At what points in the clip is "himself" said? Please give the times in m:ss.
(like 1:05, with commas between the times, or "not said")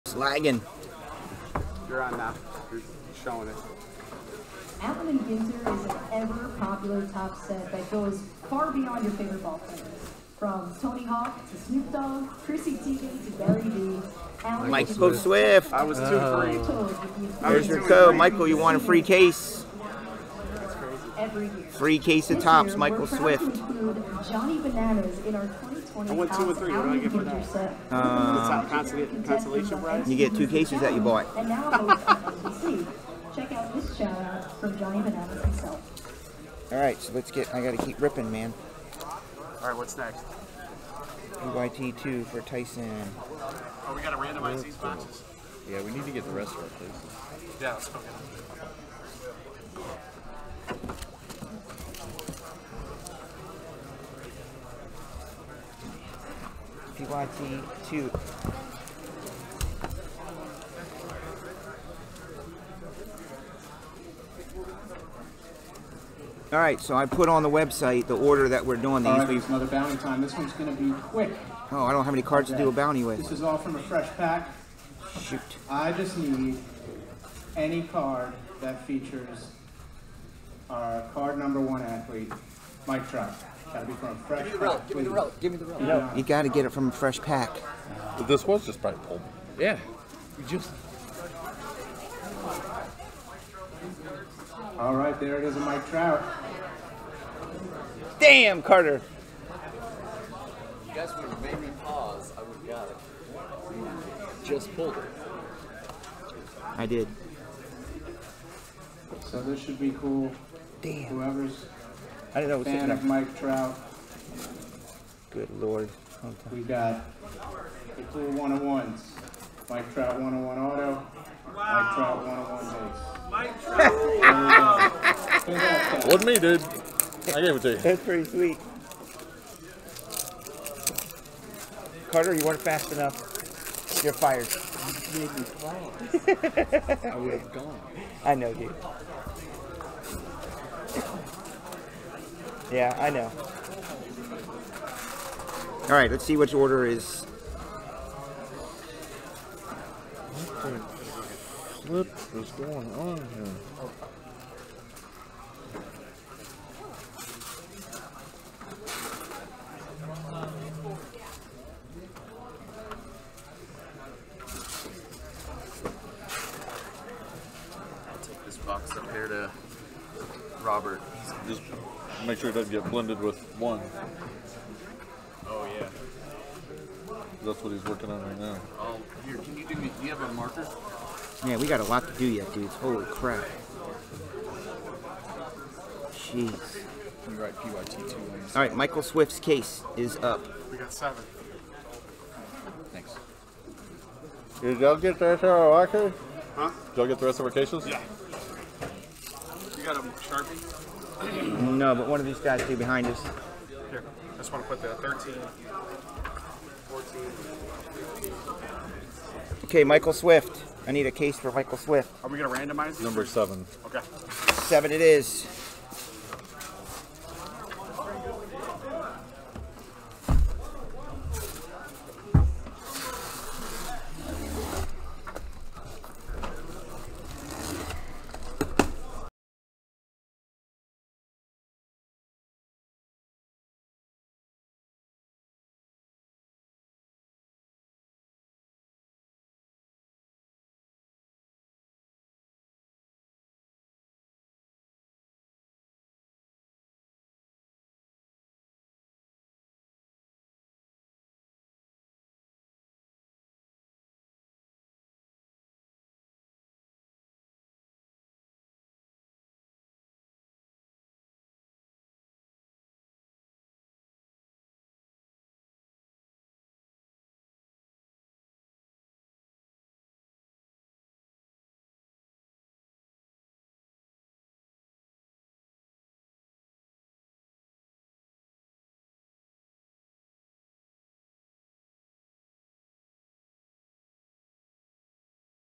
0:35.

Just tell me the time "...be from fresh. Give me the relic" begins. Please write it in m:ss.
1:23.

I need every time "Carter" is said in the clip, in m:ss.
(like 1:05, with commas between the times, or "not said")
1:38, 2:12.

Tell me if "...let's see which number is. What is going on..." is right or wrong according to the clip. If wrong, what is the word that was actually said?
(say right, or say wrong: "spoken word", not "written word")
wrong: "order", not "number".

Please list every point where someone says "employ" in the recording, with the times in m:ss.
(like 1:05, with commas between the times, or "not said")
not said.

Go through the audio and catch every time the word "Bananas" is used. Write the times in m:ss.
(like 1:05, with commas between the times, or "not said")
0:24, 0:35.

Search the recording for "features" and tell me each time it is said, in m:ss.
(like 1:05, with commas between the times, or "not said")
1:18.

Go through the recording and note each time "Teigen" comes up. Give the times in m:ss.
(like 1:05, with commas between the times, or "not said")
0:12.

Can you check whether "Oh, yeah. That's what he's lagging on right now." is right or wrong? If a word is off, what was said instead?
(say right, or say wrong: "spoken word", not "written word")
wrong: "working", not "lagging".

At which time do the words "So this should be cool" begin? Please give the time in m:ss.
1:49.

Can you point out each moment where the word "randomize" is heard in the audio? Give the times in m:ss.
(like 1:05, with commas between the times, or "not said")
0:44, 3:32.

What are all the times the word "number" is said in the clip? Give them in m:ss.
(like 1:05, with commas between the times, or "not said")
1:21, 3:33.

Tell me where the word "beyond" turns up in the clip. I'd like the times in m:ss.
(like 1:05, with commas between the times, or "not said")
0:08.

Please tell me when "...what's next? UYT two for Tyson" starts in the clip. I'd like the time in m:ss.
0:39.